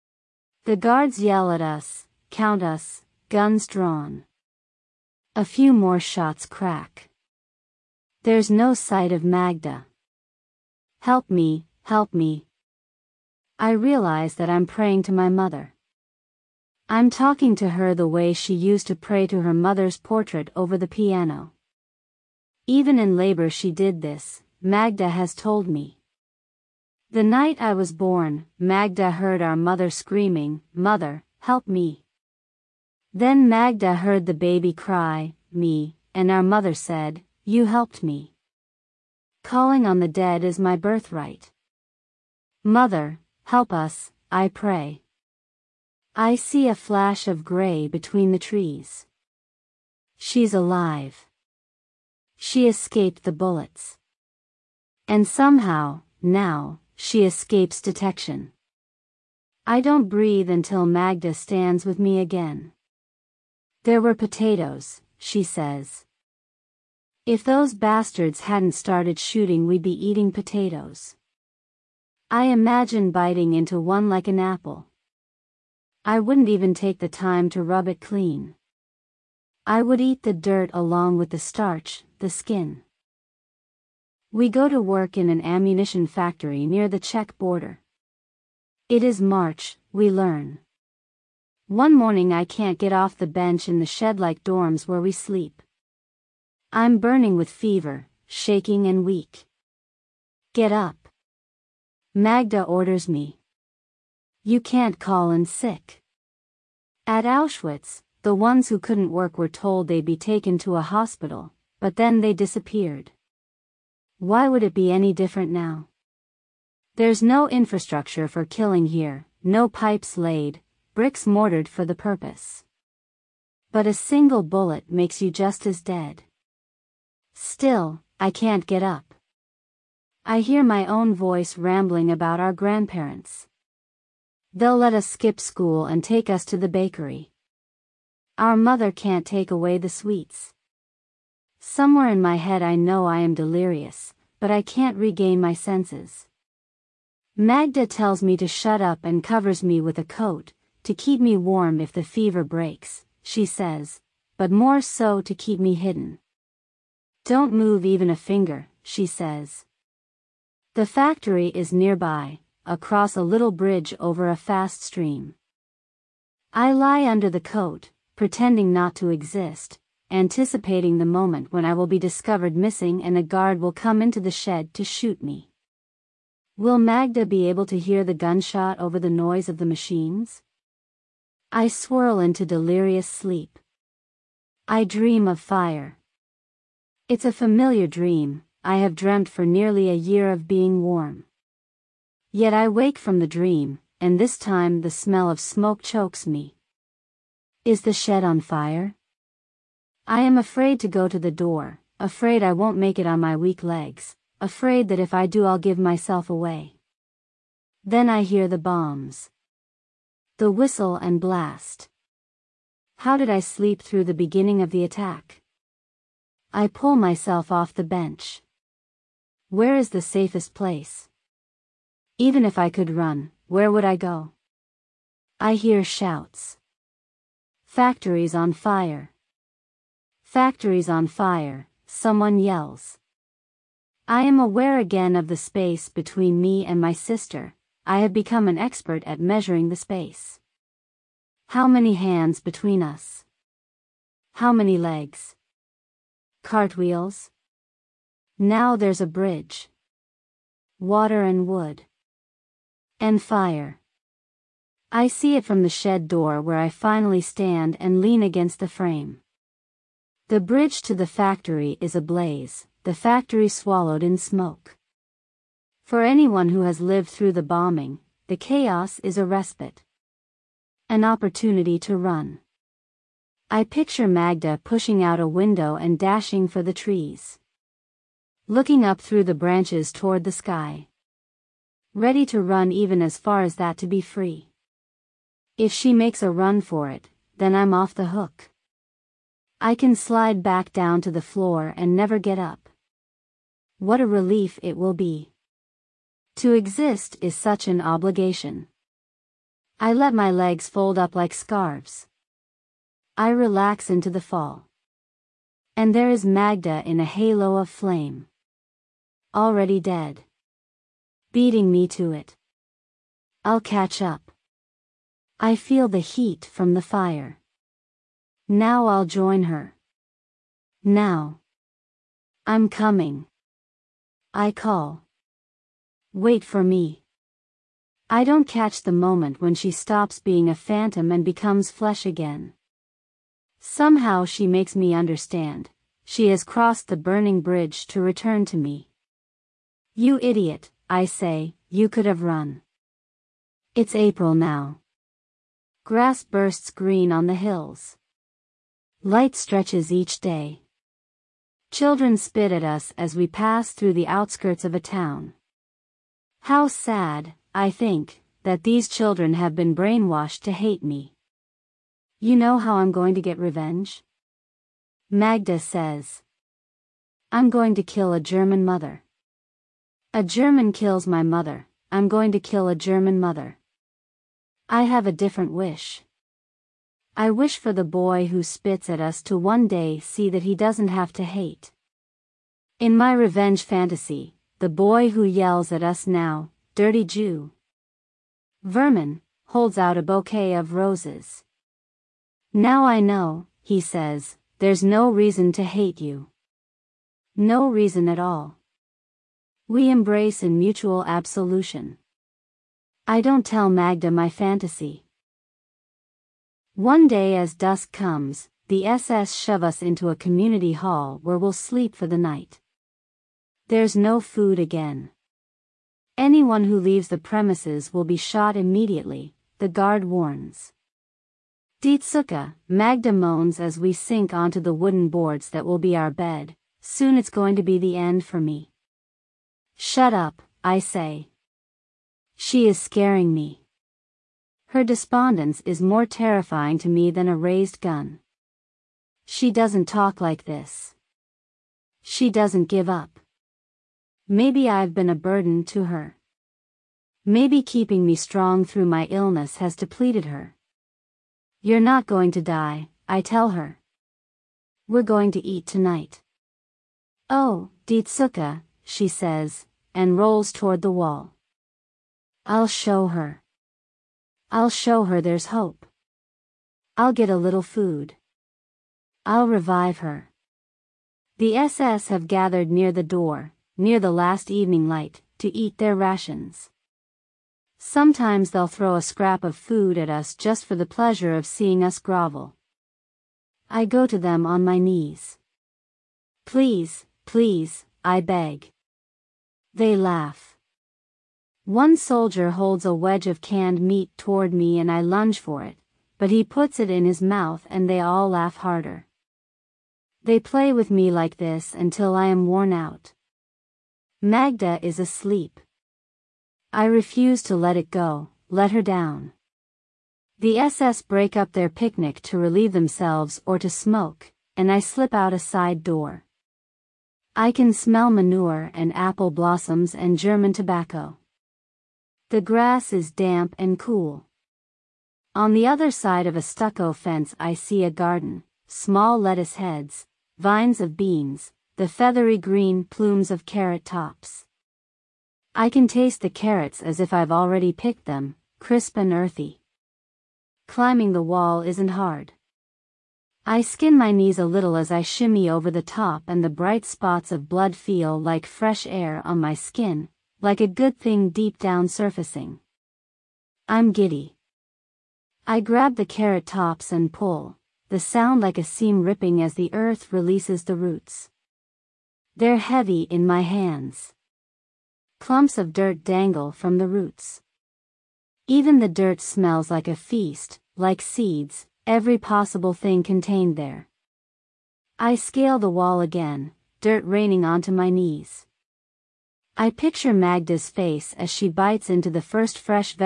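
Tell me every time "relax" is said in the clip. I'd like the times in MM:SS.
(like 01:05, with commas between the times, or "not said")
05:03.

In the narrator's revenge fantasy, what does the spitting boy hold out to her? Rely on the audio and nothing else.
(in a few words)
A bouquet of roses.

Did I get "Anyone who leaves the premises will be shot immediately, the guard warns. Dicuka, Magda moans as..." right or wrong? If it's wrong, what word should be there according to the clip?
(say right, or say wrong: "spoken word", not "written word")
right.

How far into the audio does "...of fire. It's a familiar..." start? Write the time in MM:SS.
03:05.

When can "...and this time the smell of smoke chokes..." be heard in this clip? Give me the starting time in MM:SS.
03:13.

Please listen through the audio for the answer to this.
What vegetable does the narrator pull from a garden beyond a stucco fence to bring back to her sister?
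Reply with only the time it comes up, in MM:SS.
08:56.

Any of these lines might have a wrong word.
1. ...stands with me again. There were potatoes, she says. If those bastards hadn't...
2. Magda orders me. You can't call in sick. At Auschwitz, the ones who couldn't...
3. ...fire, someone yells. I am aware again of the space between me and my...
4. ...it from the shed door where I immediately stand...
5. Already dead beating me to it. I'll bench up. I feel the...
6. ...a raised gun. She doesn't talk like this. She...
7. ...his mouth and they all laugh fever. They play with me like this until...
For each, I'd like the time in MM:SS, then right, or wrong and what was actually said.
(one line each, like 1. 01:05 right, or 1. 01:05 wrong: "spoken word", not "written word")
1. 01:01 right
2. 01:42 right
3. 03:51 right
4. 04:15 wrong: "finally", not "immediately"
5. 05:09 wrong: "catch", not "bench"
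6. 07:17 right
7. 08:17 wrong: "harder", not "fever".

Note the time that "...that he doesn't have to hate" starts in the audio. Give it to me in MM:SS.
06:20.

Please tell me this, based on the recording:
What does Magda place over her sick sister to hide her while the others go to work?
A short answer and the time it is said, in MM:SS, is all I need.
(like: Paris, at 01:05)
A coat, at 02:29.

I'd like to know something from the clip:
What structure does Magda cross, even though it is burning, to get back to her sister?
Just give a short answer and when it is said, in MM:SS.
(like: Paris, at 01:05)
The bridge, at 05:36.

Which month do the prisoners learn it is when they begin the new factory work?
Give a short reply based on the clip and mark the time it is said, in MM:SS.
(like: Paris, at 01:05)
March, at 01:28.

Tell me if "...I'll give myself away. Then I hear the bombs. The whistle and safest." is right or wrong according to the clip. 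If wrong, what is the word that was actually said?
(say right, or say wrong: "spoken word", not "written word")
wrong: "blast", not "safest".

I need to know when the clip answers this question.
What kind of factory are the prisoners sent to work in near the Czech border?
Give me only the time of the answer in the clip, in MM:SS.
01:25.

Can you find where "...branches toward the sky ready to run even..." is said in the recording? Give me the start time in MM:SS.
04:39.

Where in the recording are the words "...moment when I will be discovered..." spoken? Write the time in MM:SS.
02:51.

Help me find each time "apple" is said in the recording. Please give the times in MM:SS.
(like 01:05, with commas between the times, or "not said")
01:14, 08:38.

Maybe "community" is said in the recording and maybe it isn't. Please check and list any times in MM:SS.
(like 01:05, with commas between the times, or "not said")
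06:50.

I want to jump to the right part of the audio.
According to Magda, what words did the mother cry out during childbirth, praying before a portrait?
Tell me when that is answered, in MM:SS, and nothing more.
00:30.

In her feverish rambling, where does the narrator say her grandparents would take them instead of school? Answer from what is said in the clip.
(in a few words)
The bakery.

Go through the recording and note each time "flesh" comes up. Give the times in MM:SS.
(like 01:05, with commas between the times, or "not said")
05:31.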